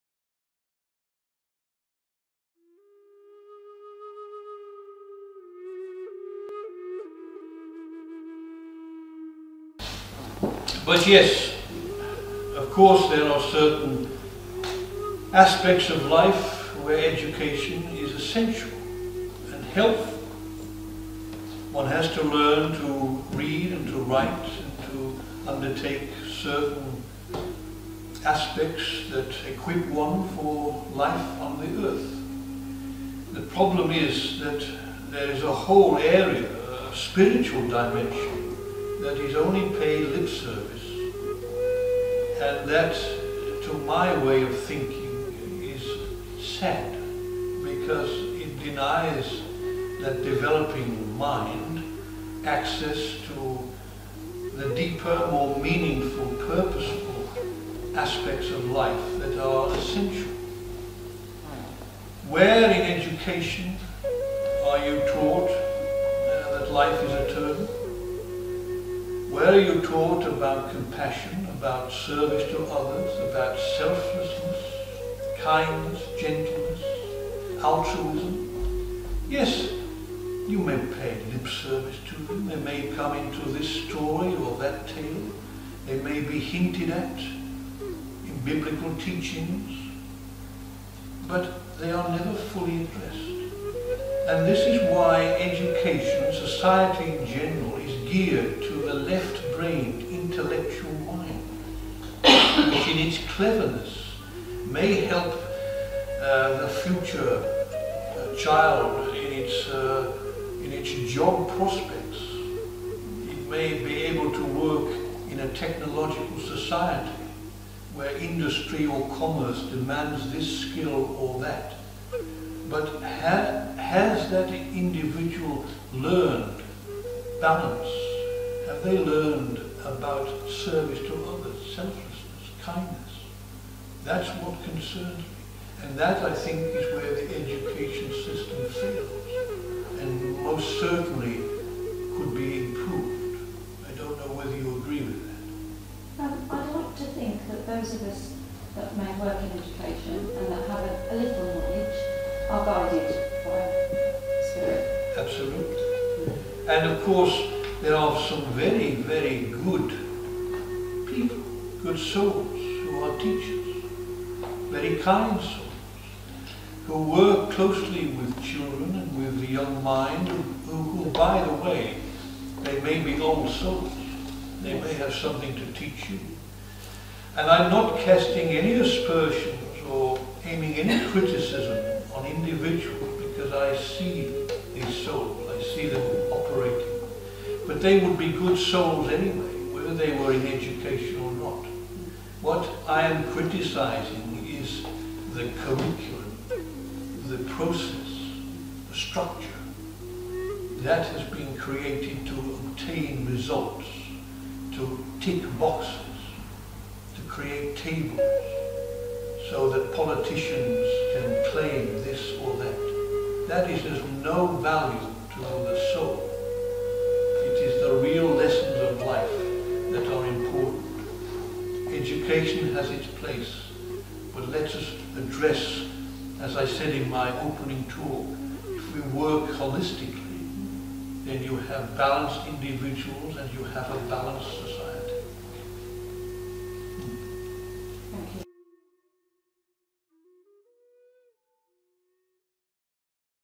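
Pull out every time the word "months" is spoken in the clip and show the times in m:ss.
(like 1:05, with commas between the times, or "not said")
not said.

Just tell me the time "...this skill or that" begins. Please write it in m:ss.
2:00.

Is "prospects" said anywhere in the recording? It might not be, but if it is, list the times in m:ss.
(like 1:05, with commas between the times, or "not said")
1:51.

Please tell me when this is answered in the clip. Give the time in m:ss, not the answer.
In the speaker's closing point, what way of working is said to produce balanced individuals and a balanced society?
3:49.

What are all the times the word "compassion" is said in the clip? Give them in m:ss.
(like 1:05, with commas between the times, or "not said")
1:10.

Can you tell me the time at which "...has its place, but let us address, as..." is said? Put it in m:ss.
3:42.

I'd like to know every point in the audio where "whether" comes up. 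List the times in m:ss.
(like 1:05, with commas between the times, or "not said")
2:24, 3:09.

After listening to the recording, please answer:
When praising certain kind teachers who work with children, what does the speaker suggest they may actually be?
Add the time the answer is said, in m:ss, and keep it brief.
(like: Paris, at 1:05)
old souls, at 2:53.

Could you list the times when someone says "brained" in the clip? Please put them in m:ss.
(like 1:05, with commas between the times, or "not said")
1:39.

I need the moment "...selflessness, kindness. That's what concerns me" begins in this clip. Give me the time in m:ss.
2:11.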